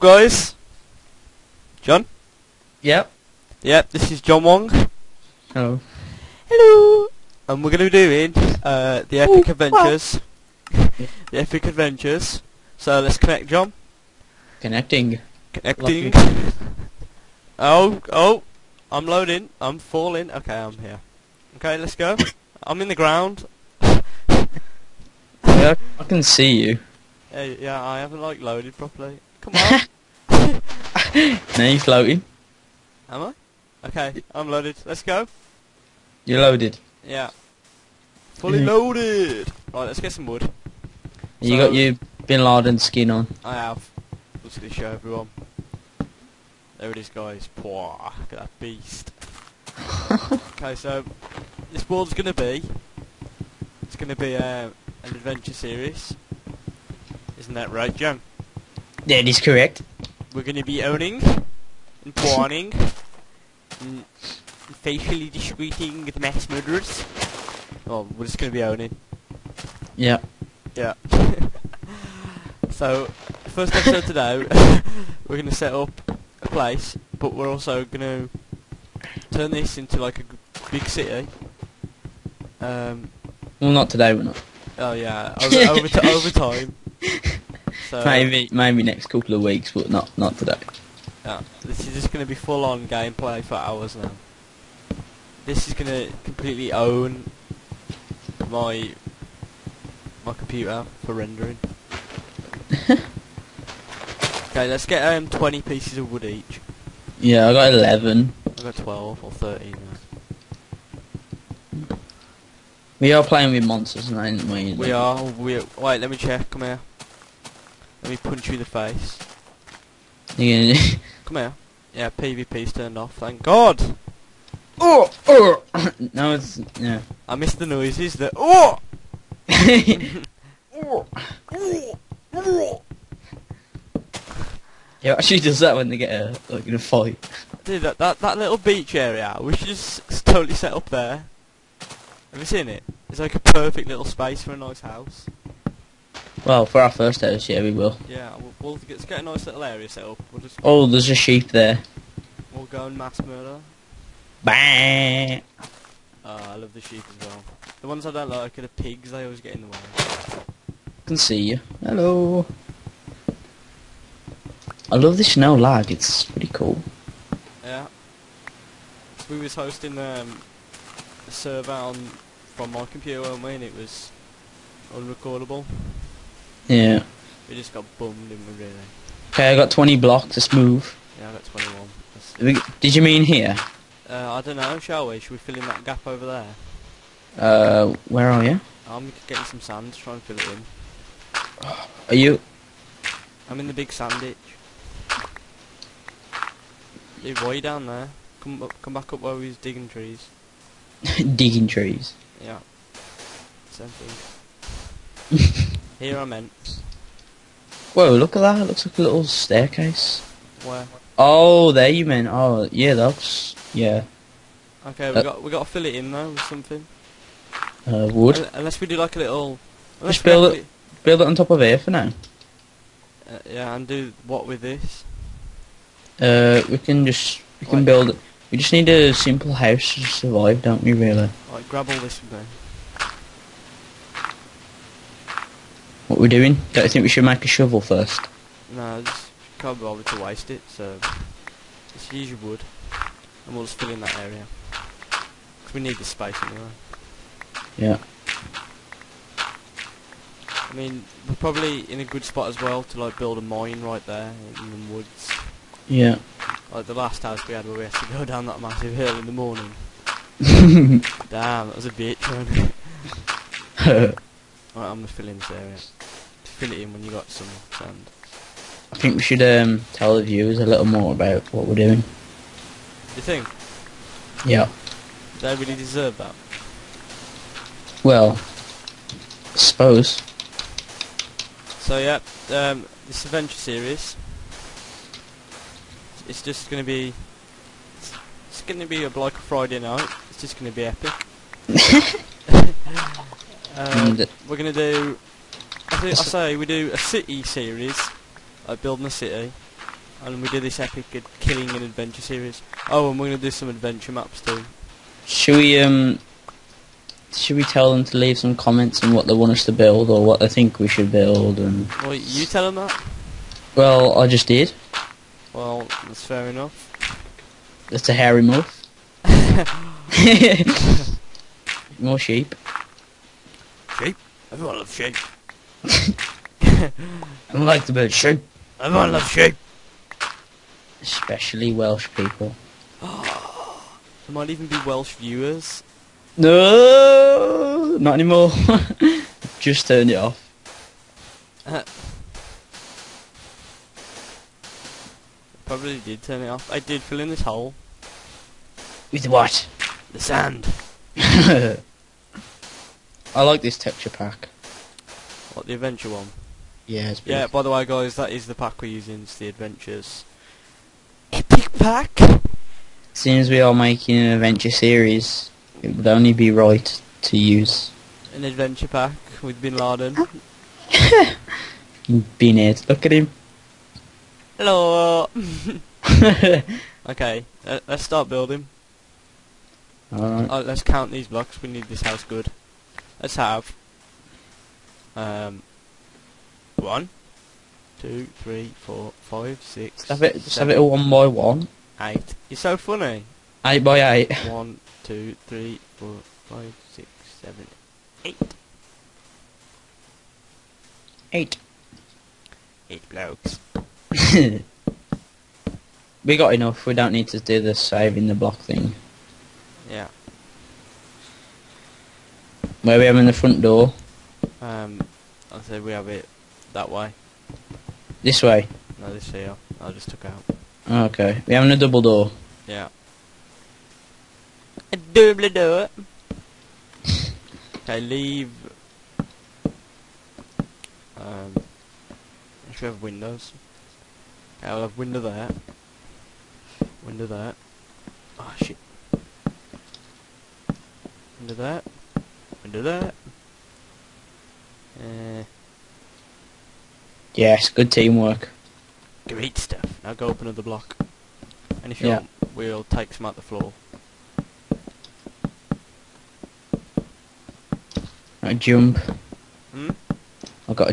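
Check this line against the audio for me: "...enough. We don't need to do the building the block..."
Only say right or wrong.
wrong.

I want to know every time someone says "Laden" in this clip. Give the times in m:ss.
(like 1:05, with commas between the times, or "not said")
0:42, 6:09.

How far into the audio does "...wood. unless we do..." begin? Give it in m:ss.
3:38.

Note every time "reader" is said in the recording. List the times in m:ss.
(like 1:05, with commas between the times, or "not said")
not said.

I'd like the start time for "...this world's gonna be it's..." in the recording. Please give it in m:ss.
0:51.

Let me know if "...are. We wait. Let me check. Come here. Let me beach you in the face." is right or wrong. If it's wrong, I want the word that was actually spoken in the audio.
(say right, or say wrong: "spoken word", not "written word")
wrong: "punch", not "beach".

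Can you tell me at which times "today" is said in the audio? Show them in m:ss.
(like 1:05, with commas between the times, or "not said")
1:14, 1:23, 1:30.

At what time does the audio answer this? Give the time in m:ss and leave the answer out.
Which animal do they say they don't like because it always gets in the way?
2:38.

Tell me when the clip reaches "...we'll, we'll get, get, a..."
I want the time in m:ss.
2:28.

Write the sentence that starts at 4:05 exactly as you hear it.
Because we need the space anyway.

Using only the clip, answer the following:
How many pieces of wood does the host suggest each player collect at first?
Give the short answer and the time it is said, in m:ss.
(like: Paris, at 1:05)
20, at 1:45.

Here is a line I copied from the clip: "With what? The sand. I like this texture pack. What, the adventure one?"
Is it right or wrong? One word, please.
right.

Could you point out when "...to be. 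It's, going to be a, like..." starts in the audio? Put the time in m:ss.
4:46.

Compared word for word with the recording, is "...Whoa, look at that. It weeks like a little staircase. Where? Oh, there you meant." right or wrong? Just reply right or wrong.
wrong.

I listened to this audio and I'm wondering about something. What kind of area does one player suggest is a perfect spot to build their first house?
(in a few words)
Beach.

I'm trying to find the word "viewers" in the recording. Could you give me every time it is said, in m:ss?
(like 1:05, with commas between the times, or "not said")
4:30, 5:35.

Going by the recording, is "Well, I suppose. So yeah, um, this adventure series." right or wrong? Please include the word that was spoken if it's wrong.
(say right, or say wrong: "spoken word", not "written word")
right.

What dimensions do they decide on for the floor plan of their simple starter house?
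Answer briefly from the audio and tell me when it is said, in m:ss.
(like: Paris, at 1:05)
8 by 8, at 6:33.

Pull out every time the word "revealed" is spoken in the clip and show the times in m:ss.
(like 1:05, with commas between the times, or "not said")
not said.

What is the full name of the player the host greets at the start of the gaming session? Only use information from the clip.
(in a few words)
John Wong.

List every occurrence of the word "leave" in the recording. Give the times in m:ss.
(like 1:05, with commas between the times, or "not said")
5:08, 7:08.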